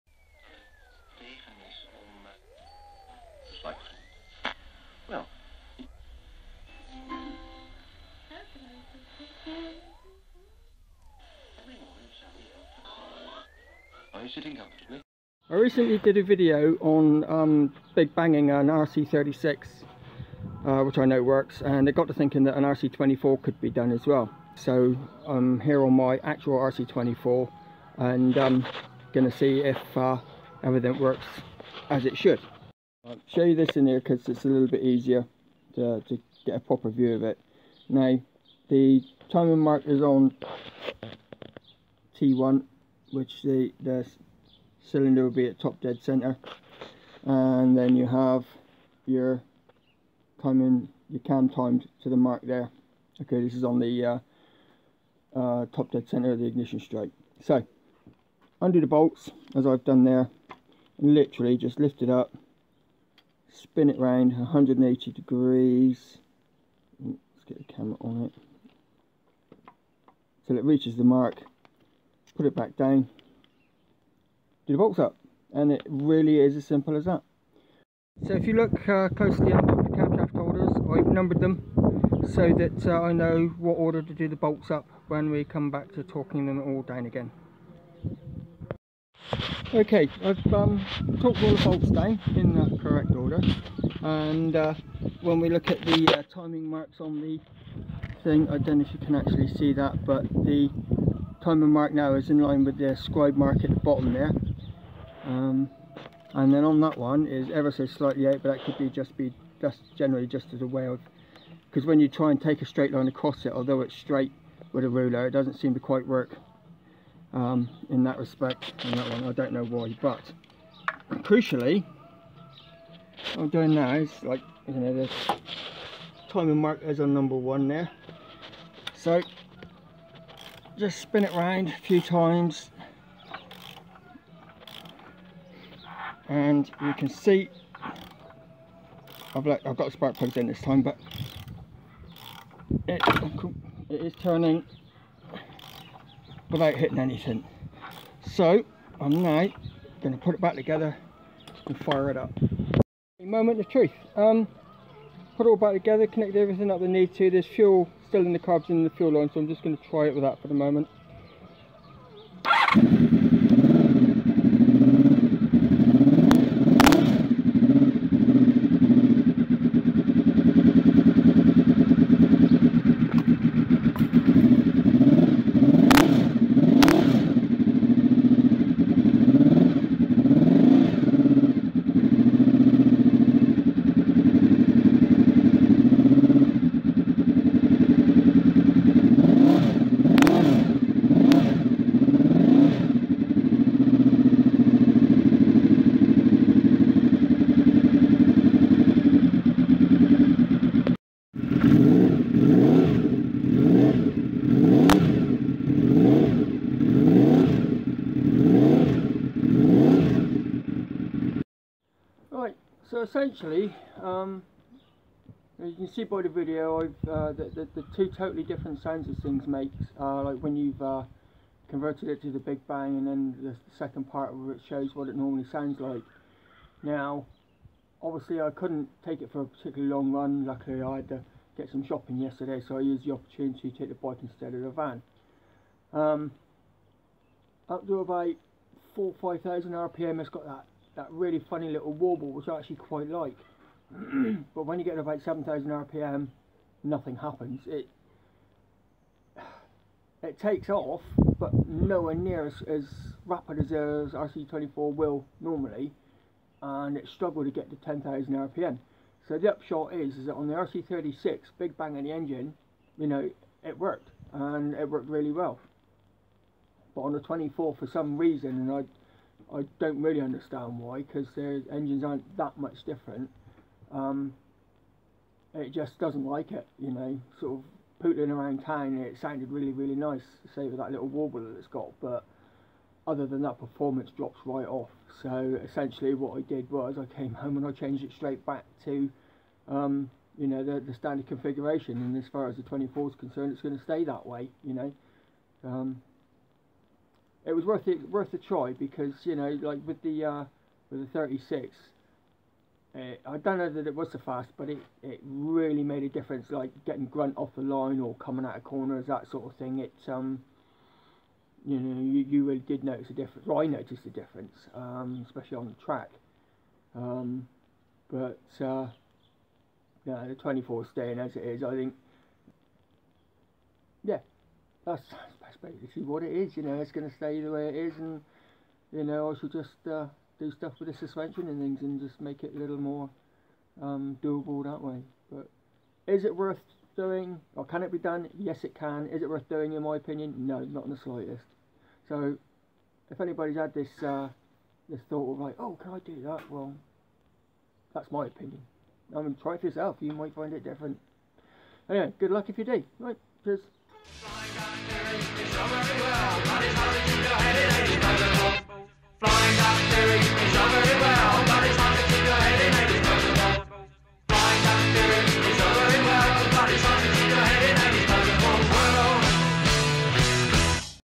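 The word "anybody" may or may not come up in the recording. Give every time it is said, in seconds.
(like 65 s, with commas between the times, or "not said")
343 s.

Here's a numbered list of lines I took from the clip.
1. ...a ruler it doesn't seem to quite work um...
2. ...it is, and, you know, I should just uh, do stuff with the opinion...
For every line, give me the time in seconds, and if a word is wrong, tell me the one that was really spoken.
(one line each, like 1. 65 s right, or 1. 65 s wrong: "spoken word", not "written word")
1. 114 s right
2. 327 s wrong: "suspension", not "opinion".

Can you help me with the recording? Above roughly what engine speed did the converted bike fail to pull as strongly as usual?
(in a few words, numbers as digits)
7000 rpm.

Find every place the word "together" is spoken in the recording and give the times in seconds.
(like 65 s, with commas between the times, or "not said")
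150 s, 155 s.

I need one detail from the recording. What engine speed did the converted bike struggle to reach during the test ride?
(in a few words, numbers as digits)
10,000 rpm.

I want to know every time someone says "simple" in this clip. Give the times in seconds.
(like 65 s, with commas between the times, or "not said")
76 s.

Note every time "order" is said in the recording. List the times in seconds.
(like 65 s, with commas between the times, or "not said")
83 s, 93 s.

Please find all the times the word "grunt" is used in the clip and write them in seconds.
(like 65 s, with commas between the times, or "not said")
307 s.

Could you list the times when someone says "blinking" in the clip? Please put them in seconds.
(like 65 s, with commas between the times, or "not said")
not said.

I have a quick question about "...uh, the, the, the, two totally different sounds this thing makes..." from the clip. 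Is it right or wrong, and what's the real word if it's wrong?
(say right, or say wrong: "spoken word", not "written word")
right.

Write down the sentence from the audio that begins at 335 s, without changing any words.
But is it worth doing, or can it be done?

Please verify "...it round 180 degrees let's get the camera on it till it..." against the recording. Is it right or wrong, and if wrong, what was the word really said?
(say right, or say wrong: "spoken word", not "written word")
right.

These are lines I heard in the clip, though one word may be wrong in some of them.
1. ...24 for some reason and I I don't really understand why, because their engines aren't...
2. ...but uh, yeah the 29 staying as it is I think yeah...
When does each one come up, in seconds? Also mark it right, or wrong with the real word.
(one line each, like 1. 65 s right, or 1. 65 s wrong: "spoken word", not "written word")
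1. 267 s right
2. 318 s wrong: "24", not "29".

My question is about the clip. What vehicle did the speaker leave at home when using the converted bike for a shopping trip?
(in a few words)
the van.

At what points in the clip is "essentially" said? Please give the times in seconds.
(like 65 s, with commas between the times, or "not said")
213 s, 285 s.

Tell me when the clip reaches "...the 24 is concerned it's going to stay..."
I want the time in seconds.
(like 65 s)
292 s.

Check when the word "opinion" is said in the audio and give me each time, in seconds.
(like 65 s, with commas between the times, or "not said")
339 s, 348 s.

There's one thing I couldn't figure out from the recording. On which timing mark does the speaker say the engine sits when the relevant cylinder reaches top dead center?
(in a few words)
T1.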